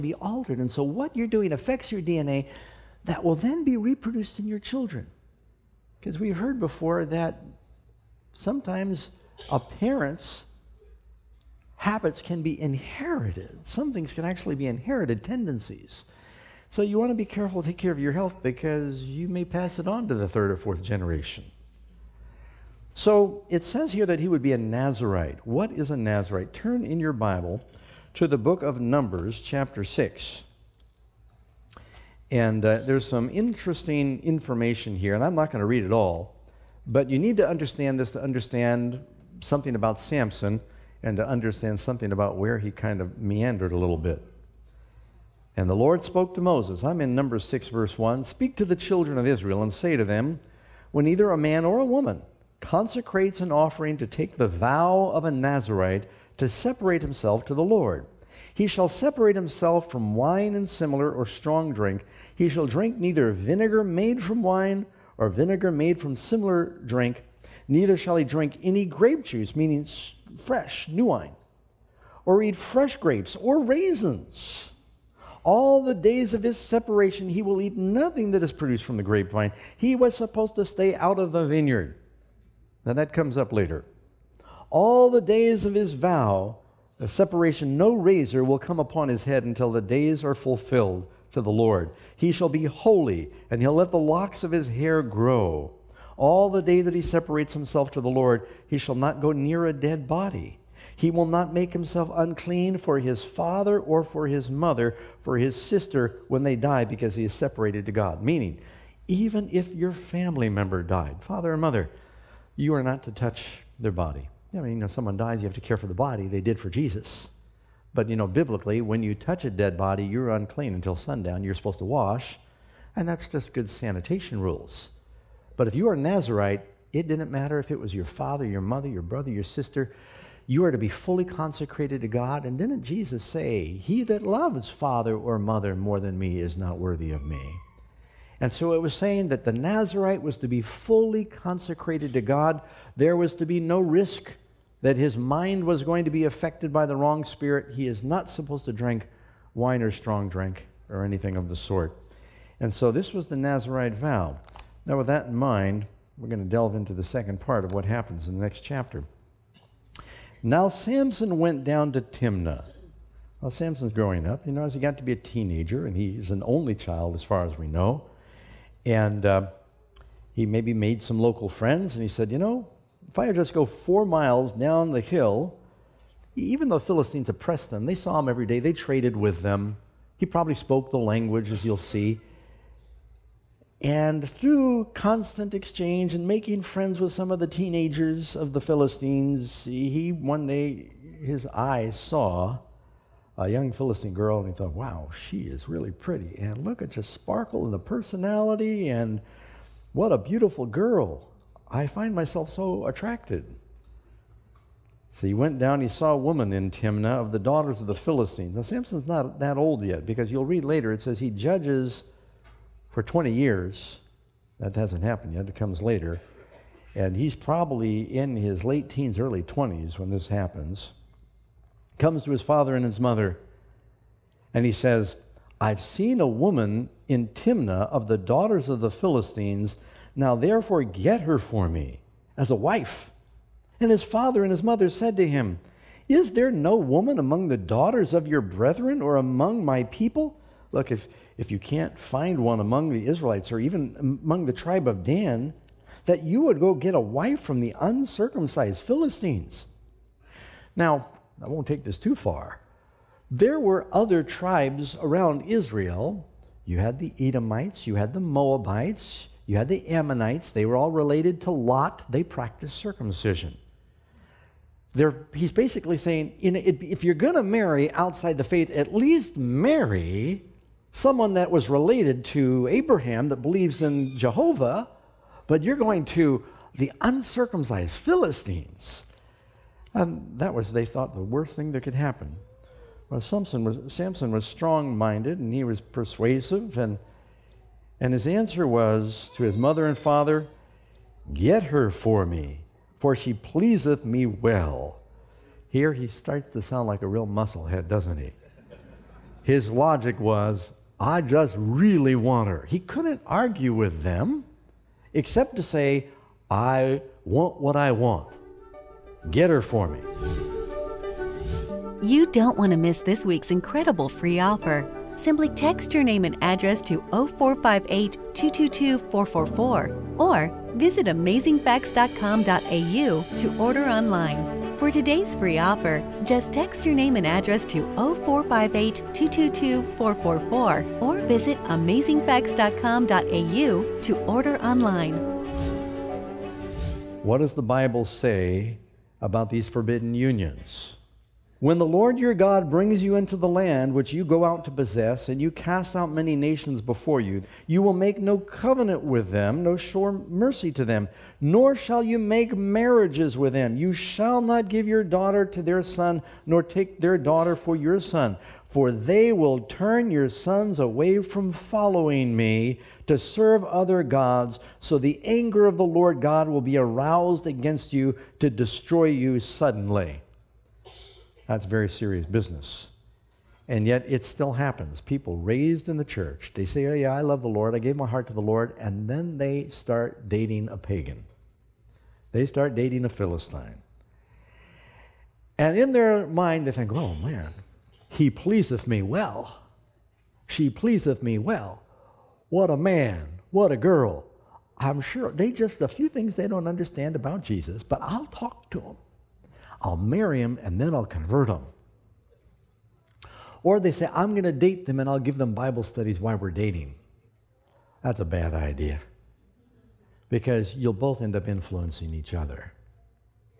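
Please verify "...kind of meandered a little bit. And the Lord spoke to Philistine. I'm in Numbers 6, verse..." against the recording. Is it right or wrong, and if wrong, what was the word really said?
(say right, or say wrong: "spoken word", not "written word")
wrong: "Moses", not "Philistine".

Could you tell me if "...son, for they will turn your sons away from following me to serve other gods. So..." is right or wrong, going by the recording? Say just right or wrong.
right.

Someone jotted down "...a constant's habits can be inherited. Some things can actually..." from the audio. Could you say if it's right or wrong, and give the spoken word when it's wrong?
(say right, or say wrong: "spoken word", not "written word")
wrong: "parent", not "constant".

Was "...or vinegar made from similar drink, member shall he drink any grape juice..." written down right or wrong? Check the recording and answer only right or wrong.
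wrong.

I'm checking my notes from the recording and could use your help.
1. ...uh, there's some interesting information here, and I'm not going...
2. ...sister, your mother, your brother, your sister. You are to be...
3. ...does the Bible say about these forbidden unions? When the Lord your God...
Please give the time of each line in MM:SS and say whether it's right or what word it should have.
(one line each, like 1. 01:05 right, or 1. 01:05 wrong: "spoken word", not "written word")
1. 00:32 right
2. 02:08 wrong: "father", not "sister"
3. 05:37 right.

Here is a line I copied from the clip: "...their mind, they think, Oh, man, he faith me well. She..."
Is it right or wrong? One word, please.
wrong.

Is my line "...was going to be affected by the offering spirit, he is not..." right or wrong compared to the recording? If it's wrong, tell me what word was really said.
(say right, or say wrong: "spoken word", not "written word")
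wrong: "wrong", not "offering".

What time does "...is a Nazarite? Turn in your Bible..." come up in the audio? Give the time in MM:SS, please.
00:25.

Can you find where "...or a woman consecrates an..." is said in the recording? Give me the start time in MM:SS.
00:51.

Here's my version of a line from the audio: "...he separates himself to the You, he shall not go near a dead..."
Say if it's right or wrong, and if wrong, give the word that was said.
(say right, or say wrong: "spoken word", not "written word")
wrong: "Lord", not "You".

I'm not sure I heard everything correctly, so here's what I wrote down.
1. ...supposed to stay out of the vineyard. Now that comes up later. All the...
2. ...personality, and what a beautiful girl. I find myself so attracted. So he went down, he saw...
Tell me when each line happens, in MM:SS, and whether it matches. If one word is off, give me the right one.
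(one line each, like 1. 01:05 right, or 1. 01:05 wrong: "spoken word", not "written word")
1. 01:20 right
2. 03:17 right.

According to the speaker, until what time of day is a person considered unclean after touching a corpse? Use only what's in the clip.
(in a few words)
Sundown.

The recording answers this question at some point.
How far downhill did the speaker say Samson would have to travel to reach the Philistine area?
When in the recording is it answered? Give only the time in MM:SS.
02:53.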